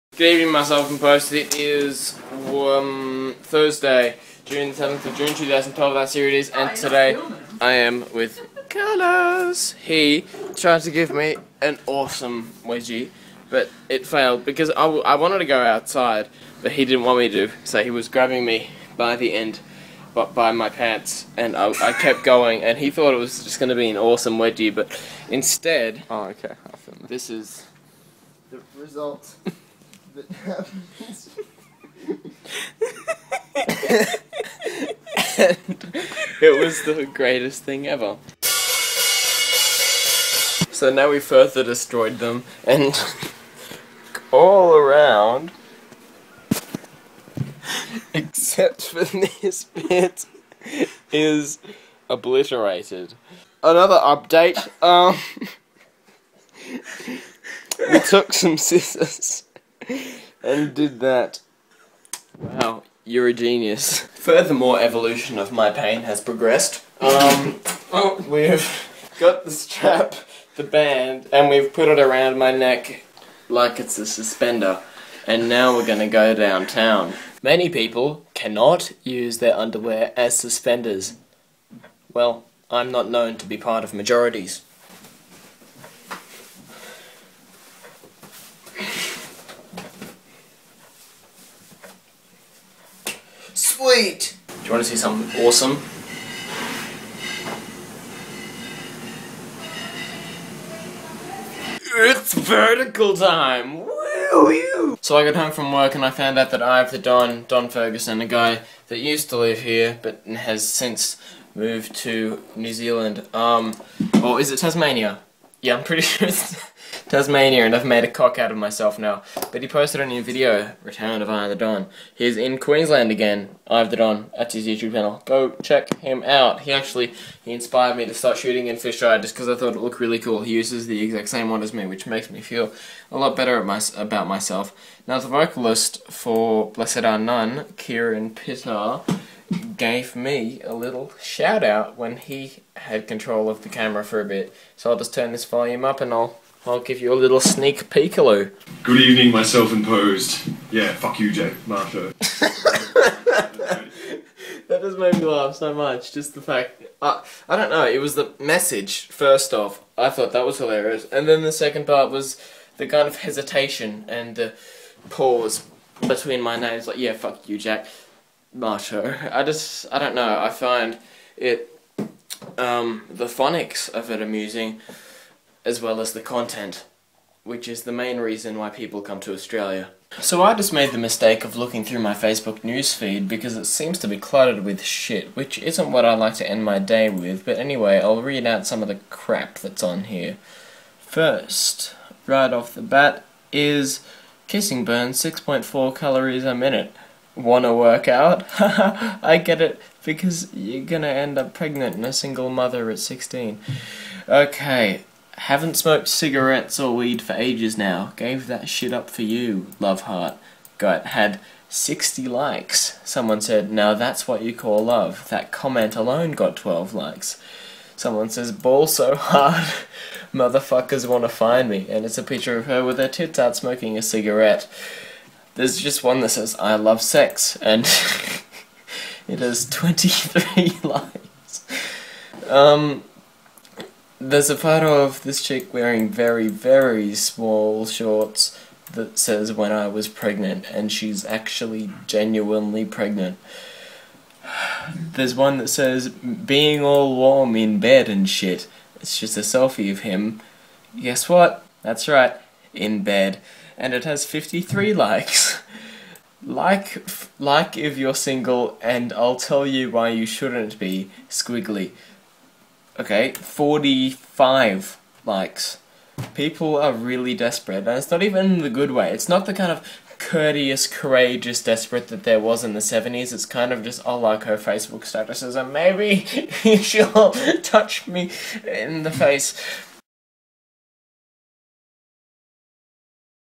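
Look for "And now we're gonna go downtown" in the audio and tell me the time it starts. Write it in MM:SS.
01:15.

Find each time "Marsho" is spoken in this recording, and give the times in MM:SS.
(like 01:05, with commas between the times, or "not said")
02:31, 02:48.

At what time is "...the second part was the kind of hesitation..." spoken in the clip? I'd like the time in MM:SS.
02:41.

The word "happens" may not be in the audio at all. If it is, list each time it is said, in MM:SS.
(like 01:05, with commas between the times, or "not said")
00:30.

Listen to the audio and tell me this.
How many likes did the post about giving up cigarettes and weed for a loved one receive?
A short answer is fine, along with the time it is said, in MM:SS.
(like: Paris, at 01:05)
60, at 03:31.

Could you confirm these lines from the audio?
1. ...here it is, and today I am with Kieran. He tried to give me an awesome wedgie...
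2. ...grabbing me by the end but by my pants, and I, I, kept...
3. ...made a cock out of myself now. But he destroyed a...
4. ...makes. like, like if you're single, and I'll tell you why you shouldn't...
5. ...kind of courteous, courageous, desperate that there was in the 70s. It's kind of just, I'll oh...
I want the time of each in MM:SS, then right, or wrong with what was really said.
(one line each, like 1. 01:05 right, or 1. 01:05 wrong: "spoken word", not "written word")
1. 00:06 wrong: "Karlis", not "Kieran"
2. 00:18 right
3. 01:57 wrong: "posted", not "destroyed"
4. 04:14 wrong: "likes", not "makes"
5. 04:29 right.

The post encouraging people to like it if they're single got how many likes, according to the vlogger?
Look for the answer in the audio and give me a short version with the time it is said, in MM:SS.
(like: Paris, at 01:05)
45, at 04:23.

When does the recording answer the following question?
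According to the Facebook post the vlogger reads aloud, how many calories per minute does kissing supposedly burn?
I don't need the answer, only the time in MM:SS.
03:15.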